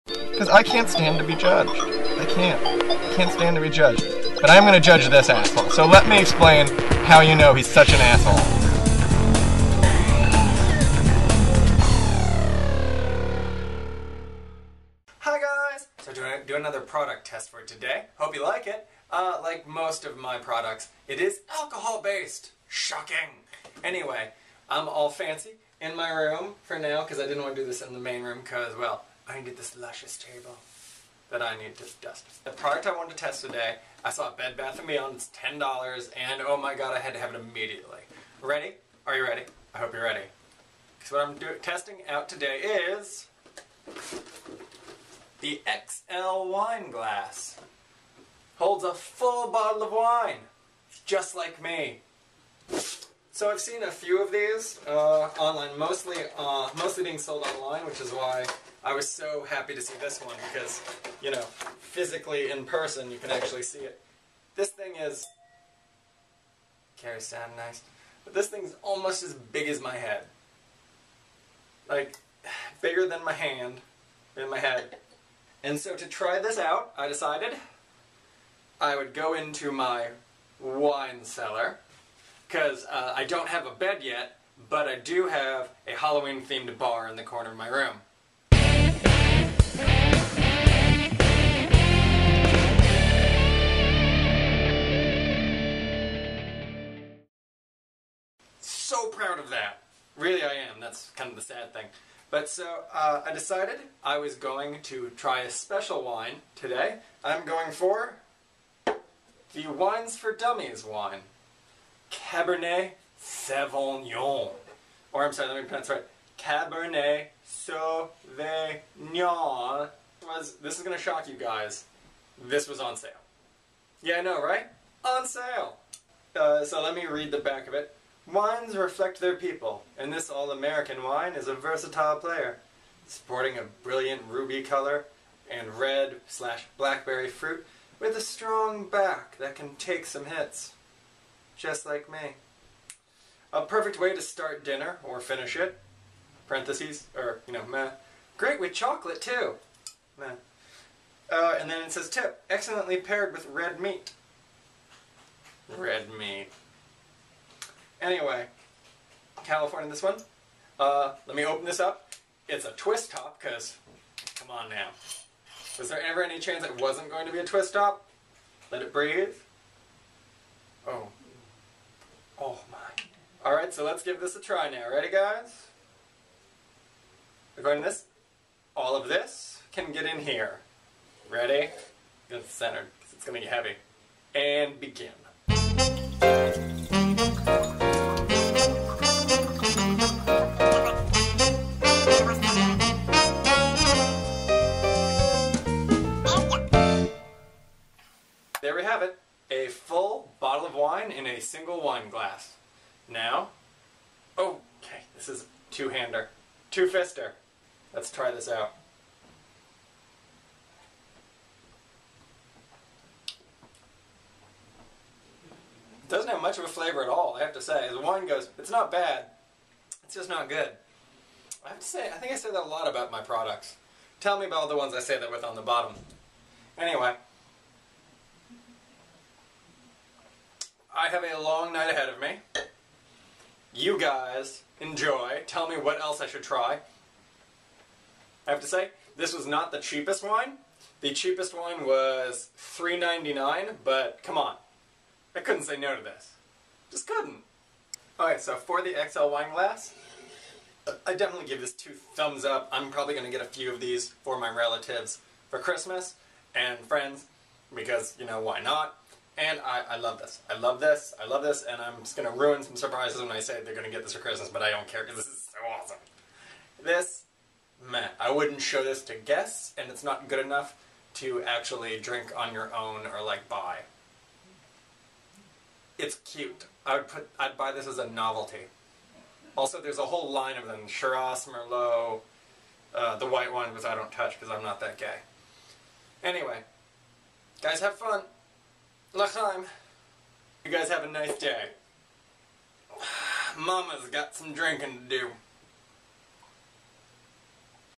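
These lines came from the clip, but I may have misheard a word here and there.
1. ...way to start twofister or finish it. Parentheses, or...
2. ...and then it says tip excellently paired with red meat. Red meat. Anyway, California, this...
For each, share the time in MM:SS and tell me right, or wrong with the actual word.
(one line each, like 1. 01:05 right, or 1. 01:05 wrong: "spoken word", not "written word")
1. 02:23 wrong: "dinner", not "twofister"
2. 02:31 right.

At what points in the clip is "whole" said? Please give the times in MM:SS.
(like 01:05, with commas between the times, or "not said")
04:40.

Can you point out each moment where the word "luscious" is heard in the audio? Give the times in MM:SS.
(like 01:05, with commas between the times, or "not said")
00:29.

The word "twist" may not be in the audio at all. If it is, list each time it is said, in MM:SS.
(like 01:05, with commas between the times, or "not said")
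02:42, 02:47.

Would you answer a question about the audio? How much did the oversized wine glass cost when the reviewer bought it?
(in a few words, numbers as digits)
$10.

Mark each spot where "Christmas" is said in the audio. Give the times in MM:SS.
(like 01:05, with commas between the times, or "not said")
04:15, 04:24.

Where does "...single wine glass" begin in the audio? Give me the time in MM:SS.
03:21.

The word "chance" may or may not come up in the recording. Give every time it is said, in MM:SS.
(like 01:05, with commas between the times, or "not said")
02:46.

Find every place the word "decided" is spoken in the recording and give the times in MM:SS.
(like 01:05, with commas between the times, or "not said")
01:17, 01:43.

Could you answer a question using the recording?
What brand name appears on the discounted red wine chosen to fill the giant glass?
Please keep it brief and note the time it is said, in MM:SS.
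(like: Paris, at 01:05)
Wines for Dummies, at 01:49.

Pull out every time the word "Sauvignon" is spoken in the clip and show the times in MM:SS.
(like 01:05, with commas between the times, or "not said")
01:53, 01:57.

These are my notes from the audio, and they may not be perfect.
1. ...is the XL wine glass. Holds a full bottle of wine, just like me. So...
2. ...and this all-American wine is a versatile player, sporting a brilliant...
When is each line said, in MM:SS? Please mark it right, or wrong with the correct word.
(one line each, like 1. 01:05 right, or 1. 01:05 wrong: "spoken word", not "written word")
1. 00:42 right
2. 02:09 right.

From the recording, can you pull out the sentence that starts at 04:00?
The cheapest one was $3.99, but come on.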